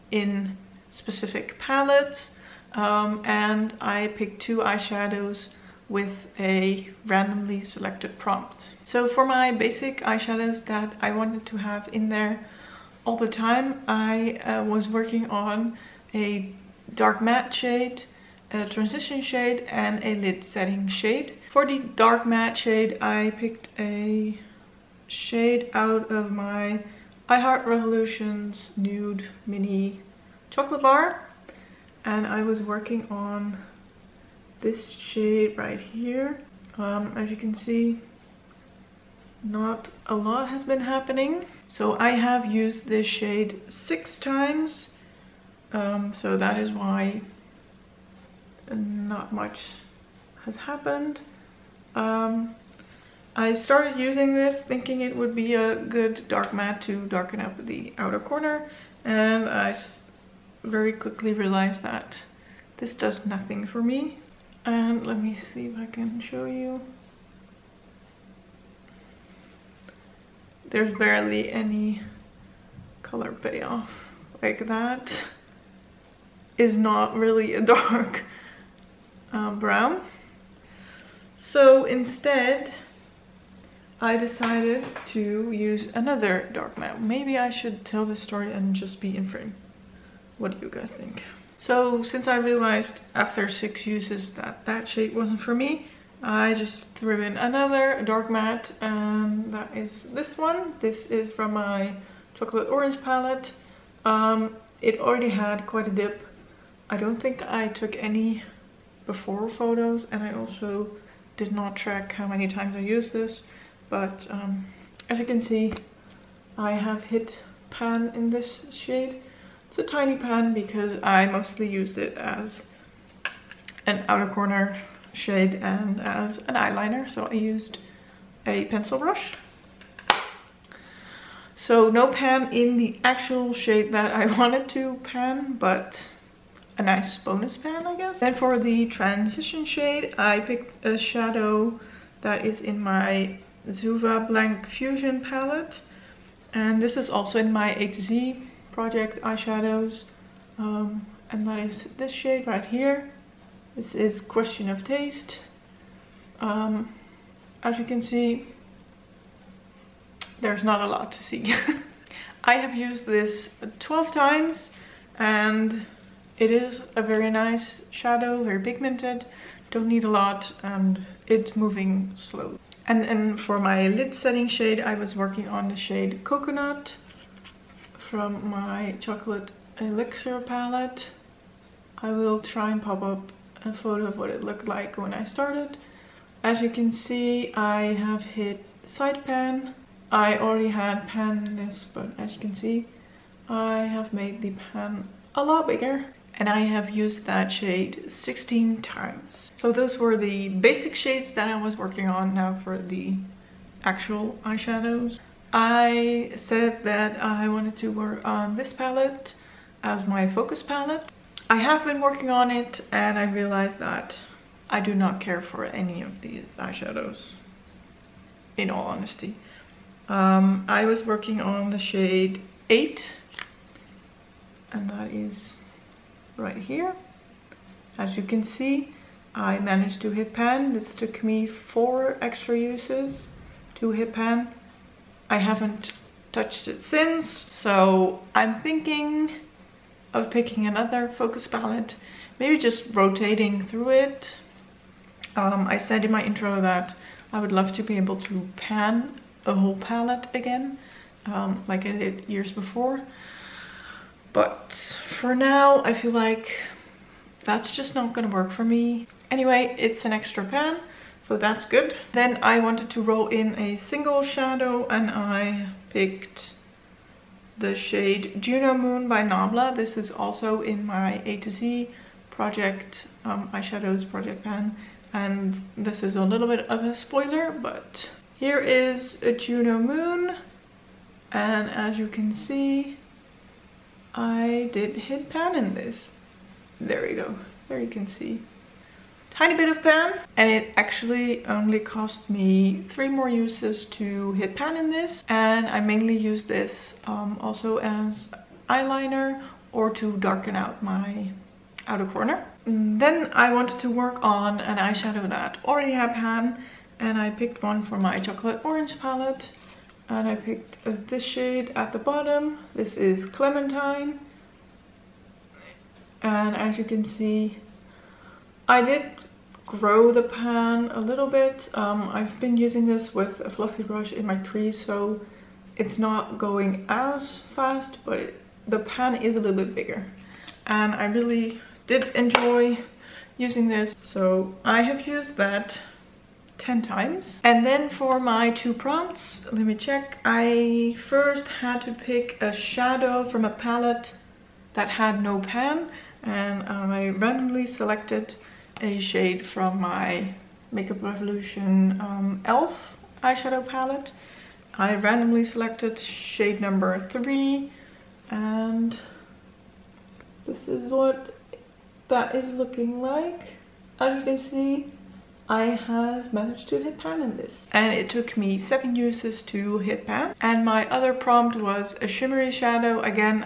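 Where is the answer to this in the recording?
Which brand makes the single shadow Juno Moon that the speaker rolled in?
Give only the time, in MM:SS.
04:29.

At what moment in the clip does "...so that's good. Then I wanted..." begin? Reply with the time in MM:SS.
04:21.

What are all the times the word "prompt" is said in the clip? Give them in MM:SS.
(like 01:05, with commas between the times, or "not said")
00:08, 05:38, 06:11.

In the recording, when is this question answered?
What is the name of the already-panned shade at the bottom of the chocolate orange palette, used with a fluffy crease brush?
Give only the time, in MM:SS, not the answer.
05:13.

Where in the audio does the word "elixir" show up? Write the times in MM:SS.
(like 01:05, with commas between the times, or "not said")
02:59.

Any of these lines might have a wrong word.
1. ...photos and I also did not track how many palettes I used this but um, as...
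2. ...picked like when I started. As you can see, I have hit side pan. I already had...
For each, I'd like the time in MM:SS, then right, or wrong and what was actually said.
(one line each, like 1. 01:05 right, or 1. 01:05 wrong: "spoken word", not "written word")
1. 01:49 wrong: "times", not "palettes"
2. 03:04 wrong: "looked", not "picked".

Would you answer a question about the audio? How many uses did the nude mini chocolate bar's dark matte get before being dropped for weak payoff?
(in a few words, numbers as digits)
6.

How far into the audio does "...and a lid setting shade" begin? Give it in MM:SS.
00:19.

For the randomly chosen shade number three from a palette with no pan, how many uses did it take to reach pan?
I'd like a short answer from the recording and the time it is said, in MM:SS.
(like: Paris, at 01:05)
7, at 06:08.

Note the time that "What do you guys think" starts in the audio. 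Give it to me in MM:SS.
01:30.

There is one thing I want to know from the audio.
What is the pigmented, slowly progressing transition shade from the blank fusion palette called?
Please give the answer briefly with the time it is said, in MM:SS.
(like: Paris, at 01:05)
Question of Taste, at 02:34.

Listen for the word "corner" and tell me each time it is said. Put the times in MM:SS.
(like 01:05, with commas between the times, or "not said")
00:58, 02:04, 05:02.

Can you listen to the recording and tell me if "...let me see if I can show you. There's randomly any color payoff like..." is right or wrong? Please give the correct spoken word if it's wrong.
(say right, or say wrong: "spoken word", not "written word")
wrong: "barely", not "randomly".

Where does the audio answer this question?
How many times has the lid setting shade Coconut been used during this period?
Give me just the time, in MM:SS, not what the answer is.
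03:18.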